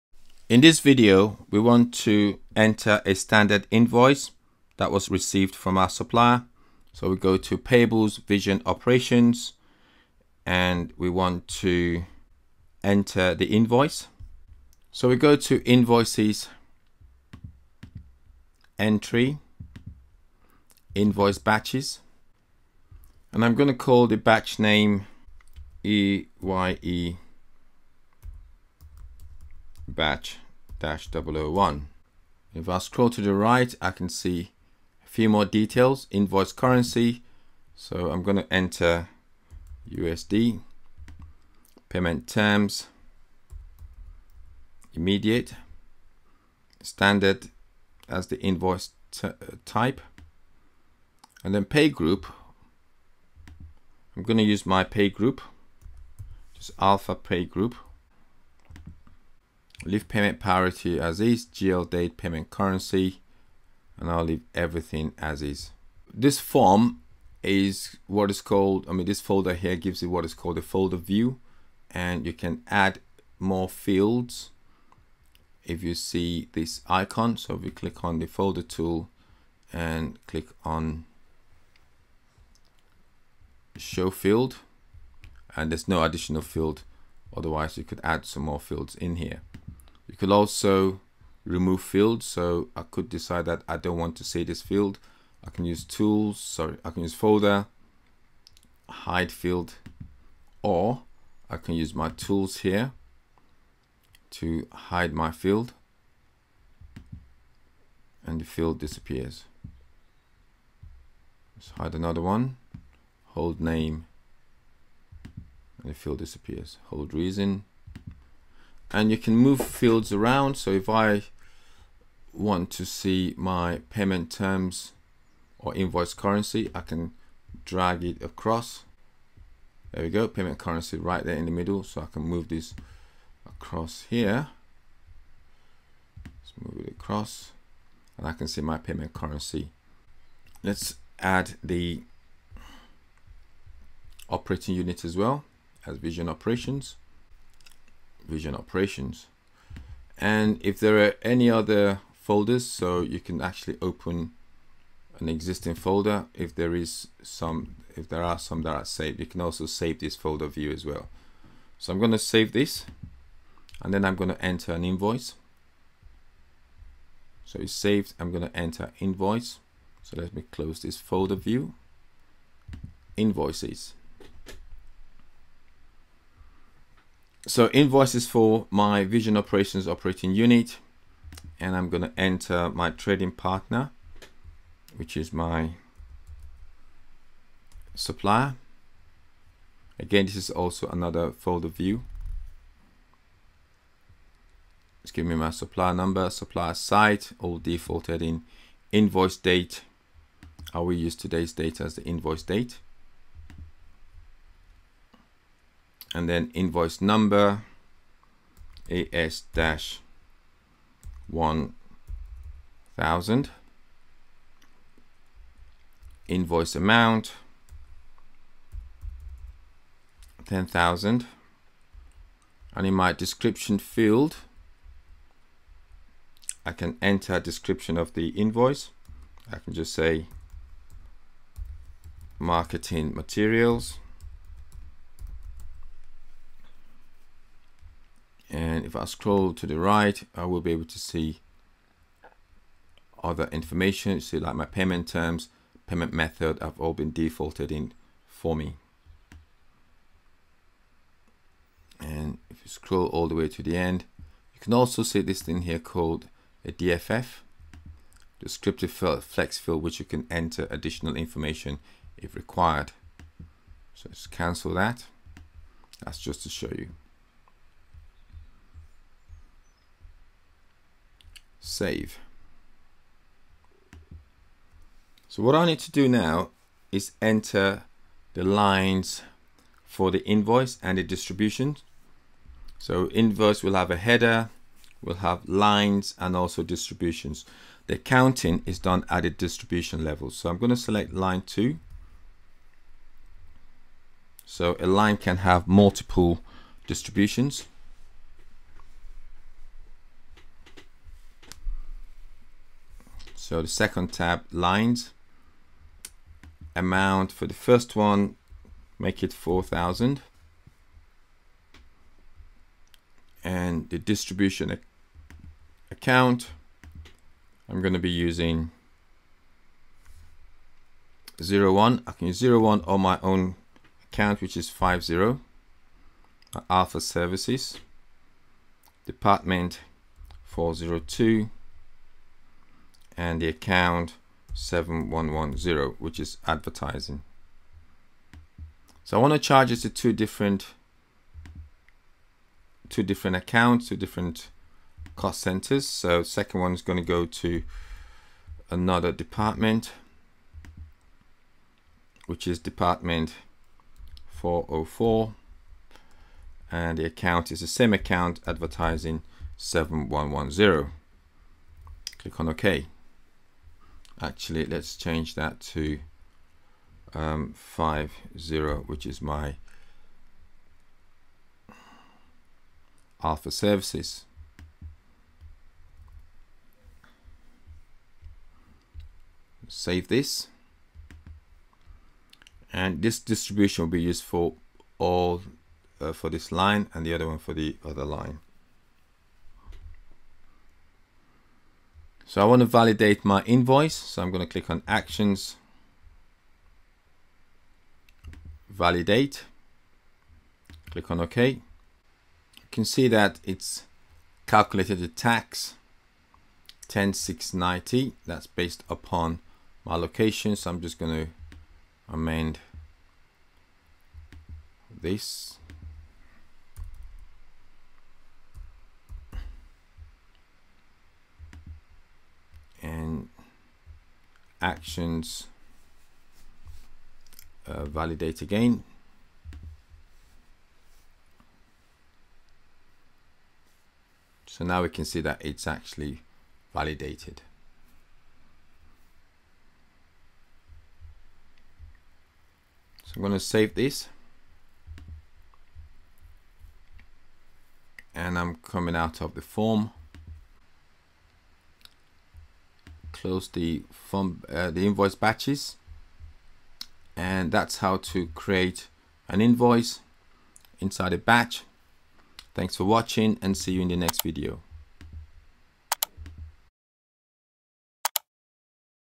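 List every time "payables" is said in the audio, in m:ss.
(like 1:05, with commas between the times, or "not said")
0:07.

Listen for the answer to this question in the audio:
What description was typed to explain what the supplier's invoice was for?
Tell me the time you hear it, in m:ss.
3:52.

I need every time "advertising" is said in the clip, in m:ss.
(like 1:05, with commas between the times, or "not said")
5:36, 5:58.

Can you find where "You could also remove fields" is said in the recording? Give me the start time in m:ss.
1:30.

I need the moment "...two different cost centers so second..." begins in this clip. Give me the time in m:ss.
5:43.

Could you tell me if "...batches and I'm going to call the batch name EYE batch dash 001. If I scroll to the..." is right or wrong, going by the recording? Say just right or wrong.
right.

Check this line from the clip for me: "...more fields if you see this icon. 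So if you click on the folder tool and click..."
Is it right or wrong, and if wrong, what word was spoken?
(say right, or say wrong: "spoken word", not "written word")
right.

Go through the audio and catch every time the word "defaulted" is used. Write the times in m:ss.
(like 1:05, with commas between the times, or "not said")
3:17, 4:07.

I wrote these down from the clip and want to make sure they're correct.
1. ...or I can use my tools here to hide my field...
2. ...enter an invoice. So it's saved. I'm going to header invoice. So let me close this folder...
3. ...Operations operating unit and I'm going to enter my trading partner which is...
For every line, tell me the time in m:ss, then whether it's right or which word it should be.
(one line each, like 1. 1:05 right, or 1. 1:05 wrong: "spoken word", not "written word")
1. 1:40 right
2. 2:44 wrong: "enter", not "header"
3. 2:59 right.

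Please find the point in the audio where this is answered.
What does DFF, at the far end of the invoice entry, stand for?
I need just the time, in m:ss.
4:18.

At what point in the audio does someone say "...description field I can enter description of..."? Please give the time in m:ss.
3:43.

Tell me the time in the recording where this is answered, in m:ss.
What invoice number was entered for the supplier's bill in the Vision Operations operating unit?
3:28.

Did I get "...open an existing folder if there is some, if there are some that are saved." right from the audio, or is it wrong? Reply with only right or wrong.
right.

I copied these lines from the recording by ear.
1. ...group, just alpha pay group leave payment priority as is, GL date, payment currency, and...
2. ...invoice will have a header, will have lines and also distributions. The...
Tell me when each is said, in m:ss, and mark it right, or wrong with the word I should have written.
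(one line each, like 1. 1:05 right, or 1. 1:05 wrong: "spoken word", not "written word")
1. 0:55 right
2. 4:43 right.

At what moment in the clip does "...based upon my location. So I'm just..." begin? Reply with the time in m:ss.
6:48.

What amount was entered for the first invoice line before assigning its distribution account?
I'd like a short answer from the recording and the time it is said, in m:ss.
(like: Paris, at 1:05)
4,000, at 5:09.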